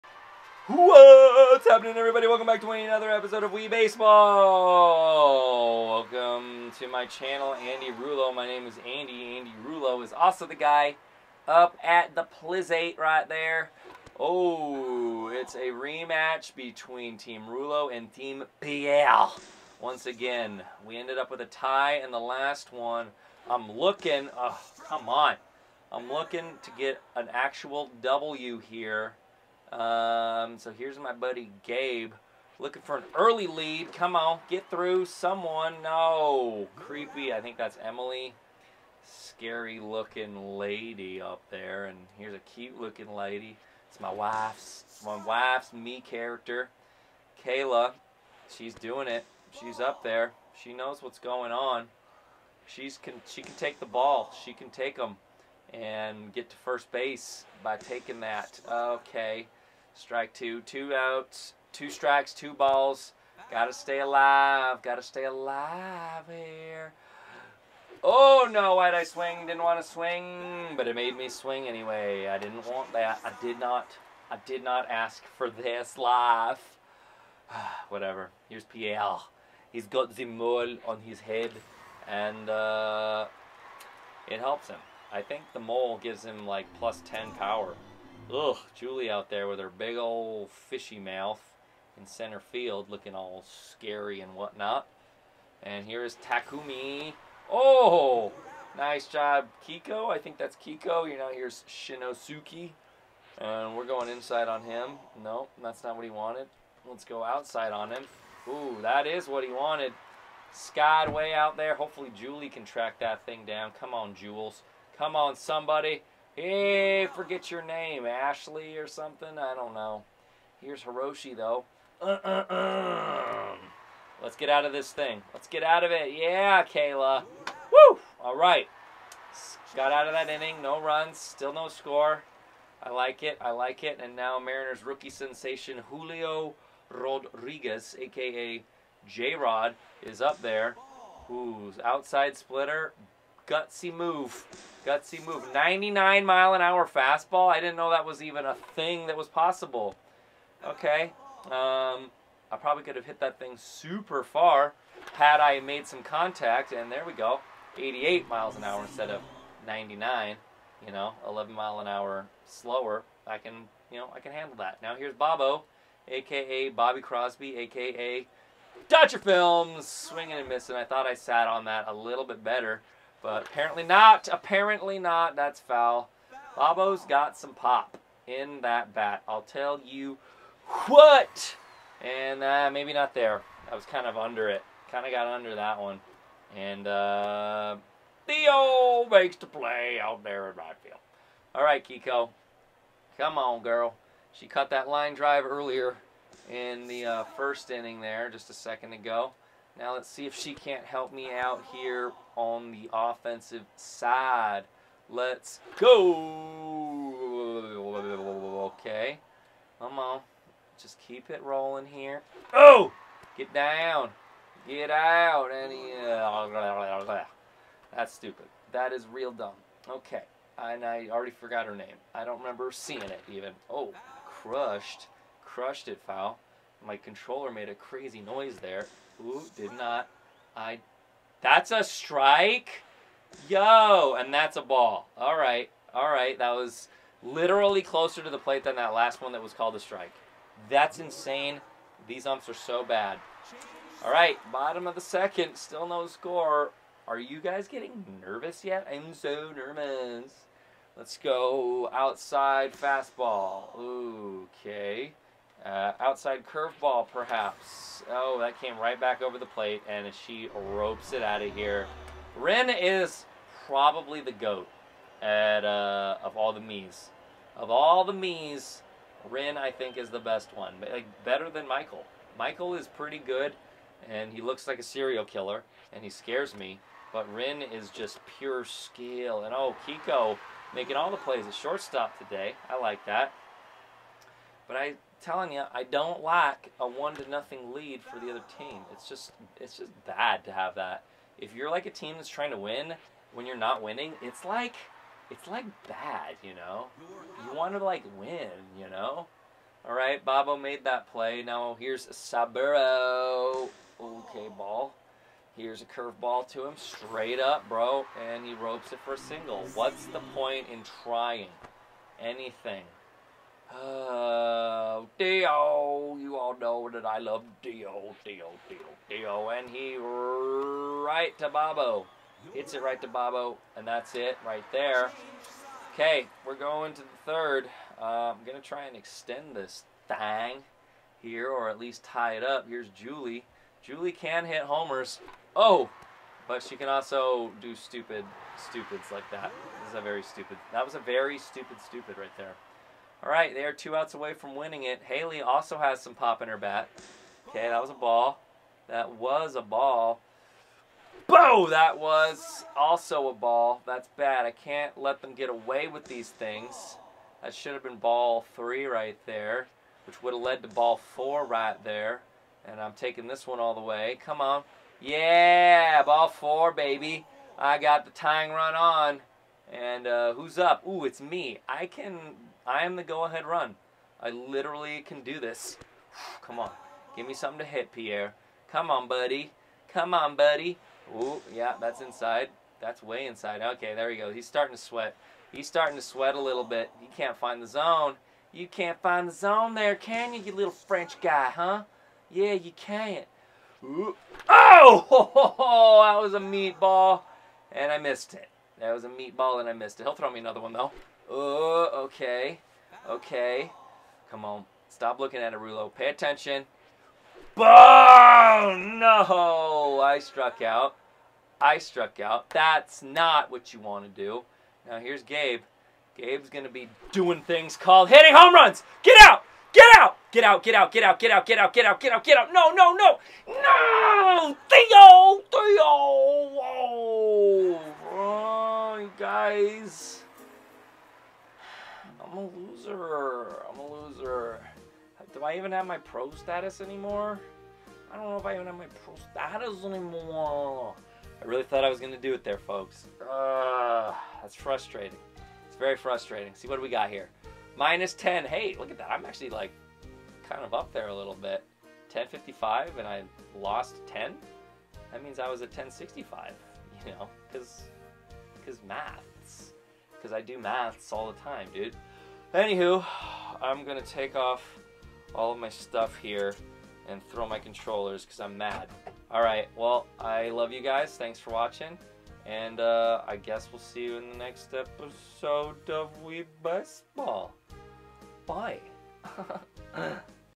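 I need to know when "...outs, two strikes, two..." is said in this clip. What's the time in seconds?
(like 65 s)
60 s.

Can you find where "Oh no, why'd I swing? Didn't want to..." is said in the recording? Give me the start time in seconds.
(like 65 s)
68 s.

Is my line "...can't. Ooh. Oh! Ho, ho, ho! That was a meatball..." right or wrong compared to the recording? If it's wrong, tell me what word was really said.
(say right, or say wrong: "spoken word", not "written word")
right.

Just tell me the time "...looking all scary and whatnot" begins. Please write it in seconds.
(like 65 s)
92 s.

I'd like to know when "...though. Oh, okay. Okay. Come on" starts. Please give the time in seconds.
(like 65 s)
400 s.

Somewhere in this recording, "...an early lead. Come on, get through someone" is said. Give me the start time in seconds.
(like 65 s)
32 s.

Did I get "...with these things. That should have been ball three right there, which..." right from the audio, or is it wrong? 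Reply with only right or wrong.
right.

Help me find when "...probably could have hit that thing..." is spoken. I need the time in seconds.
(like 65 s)
152 s.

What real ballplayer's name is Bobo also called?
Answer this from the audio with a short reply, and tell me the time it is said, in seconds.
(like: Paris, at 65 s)
Bobby Crosby, at 166 s.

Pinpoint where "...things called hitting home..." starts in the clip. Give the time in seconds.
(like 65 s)
417 s.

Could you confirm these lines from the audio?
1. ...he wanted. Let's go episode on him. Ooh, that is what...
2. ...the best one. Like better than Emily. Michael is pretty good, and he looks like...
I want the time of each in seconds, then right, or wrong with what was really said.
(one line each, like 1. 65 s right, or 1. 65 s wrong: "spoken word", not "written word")
1. 106 s wrong: "outside", not "episode"
2. 270 s wrong: "Michael", not "Emily".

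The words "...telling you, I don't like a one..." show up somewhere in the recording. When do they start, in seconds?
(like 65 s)
285 s.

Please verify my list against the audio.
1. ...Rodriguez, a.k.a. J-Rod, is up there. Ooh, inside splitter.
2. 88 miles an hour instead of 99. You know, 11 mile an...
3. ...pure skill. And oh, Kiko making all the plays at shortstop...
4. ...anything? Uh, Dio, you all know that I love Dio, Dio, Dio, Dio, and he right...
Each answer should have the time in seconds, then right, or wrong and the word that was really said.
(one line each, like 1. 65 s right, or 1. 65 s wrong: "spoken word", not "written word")
1. 136 s wrong: "outside", not "inside"
2. 157 s right
3. 278 s right
4. 312 s right.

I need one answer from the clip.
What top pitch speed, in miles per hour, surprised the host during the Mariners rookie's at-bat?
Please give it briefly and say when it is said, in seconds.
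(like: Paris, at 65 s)
99, at 145 s.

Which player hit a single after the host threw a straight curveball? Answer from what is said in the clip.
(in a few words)
Saburo.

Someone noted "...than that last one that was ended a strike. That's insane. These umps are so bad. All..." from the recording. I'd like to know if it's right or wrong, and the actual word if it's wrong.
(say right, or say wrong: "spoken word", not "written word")
wrong: "called", not "ended".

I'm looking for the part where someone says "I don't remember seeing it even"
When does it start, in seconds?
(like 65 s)
222 s.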